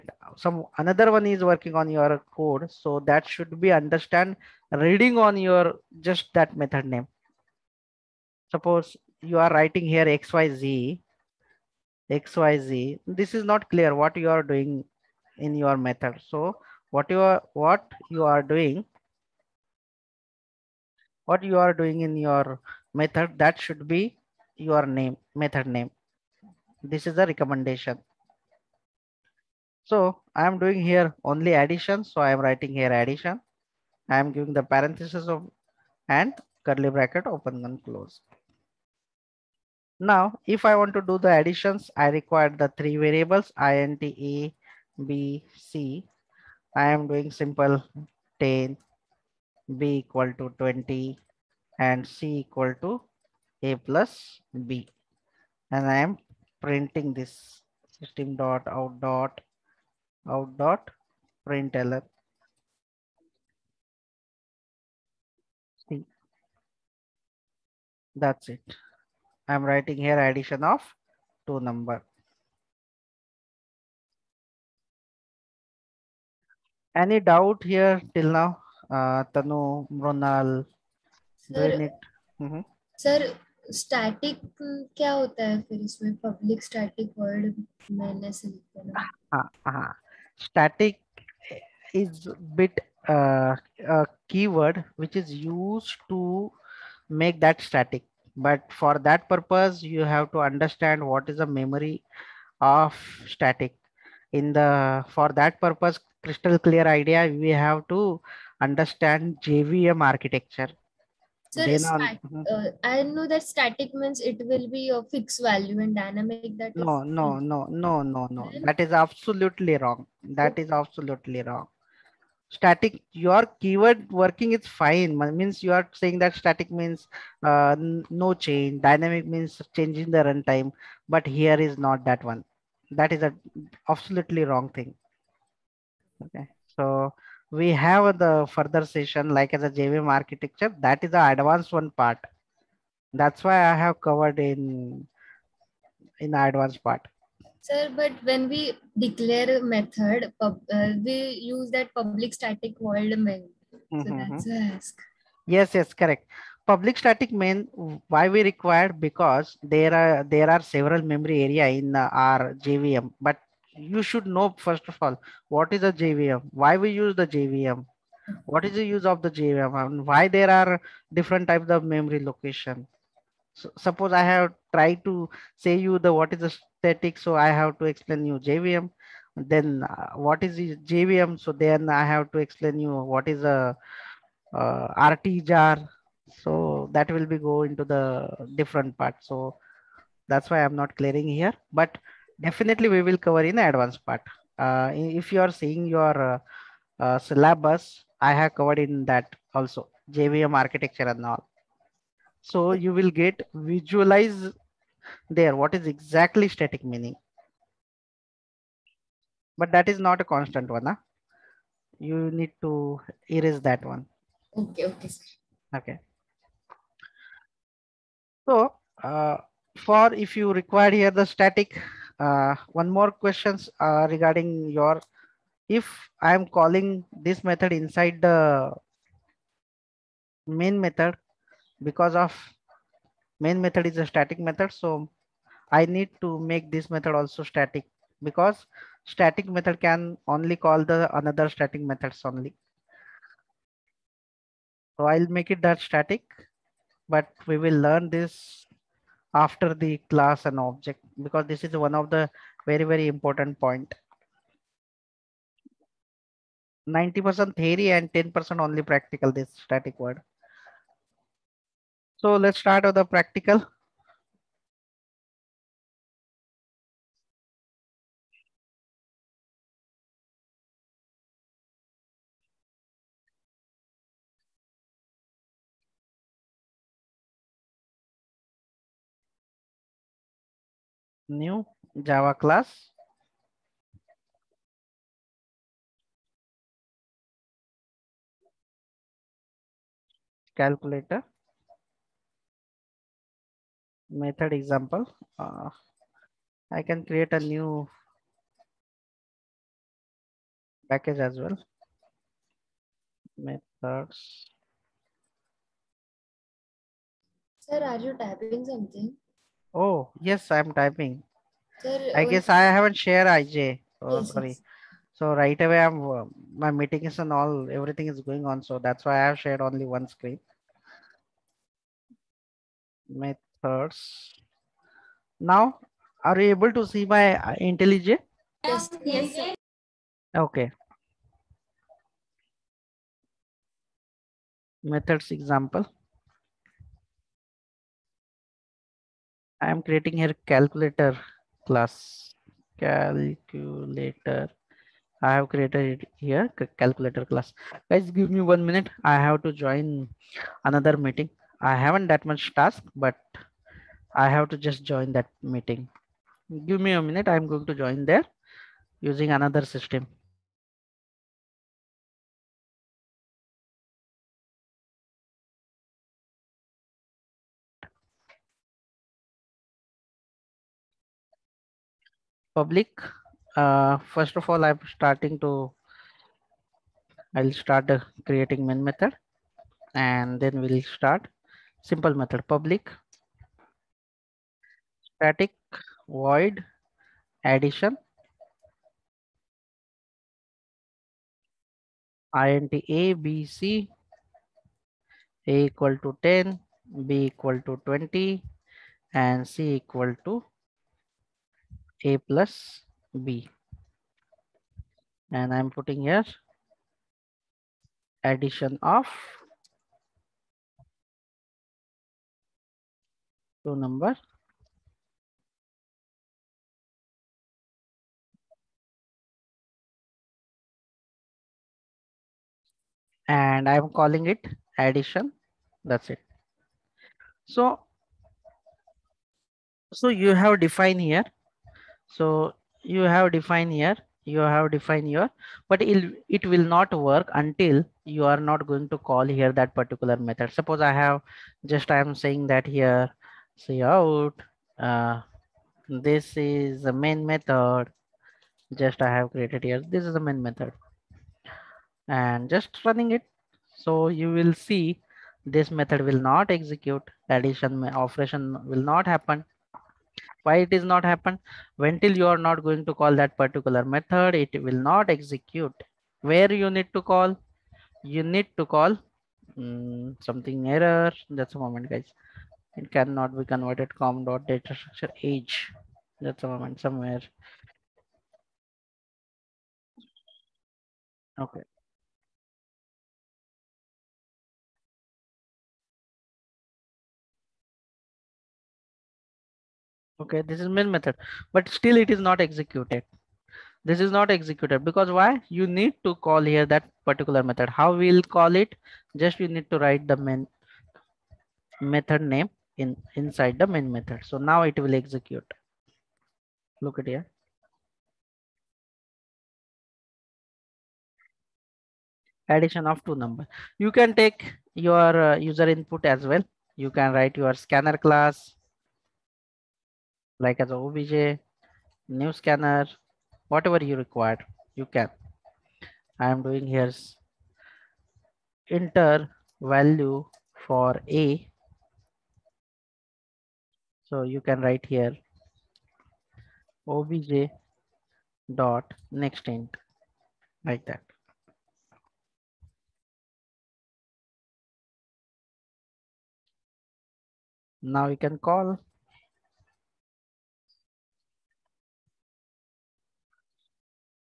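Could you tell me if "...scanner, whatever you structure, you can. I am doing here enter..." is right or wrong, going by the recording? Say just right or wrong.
wrong.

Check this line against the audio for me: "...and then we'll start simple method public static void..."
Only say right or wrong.
right.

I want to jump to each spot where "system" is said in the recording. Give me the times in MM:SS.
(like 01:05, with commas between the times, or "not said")
00:57, 05:59.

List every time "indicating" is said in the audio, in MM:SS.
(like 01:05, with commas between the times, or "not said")
not said.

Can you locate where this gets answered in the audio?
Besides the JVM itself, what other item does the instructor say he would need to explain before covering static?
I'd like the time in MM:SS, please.
03:05.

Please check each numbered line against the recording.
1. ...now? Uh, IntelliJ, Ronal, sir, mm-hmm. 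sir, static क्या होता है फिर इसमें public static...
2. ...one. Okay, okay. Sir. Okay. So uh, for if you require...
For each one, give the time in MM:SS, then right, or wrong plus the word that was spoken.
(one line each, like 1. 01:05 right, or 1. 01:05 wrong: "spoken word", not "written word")
1. 01:18 wrong: "Tanu", not "IntelliJ"
2. 03:33 right.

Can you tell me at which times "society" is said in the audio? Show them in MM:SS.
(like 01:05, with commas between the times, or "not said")
not said.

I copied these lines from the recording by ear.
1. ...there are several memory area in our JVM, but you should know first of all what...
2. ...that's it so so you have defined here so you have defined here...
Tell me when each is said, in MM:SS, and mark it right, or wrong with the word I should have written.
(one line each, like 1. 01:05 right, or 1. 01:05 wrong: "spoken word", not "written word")
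1. 02:40 right
2. 07:05 right.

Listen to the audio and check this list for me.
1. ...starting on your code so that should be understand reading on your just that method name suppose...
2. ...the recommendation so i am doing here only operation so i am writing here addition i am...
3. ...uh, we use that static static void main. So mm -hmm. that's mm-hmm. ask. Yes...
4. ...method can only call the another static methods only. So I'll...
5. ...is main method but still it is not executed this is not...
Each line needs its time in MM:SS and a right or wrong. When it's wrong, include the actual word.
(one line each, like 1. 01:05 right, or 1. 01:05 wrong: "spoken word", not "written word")
1. 00:01 wrong: "working", not "starting"
2. 00:27 wrong: "addition", not "operation"
3. 02:30 wrong: "public", not "static"
4. 03:59 right
5. 08:10 right.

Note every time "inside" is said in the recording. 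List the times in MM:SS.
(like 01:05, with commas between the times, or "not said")
03:47, 08:23.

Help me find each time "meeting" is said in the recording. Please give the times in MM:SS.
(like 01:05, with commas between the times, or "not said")
05:16, 05:50, 05:55.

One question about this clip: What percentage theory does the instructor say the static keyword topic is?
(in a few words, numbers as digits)
90%.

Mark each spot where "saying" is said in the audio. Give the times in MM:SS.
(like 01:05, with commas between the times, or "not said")
02:05, 07:22.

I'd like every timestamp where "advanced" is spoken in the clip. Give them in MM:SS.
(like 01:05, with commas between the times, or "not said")
02:21, 02:26, 03:13.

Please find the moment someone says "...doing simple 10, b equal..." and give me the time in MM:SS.
00:47.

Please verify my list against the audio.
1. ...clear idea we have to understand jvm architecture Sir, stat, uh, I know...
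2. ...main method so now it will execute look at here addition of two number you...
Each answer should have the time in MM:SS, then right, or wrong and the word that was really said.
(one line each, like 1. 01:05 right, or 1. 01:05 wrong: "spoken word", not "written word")
1. 01:46 right
2. 08:23 right.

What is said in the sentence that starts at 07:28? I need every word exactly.
Just I have created here, this is the main method and just running it.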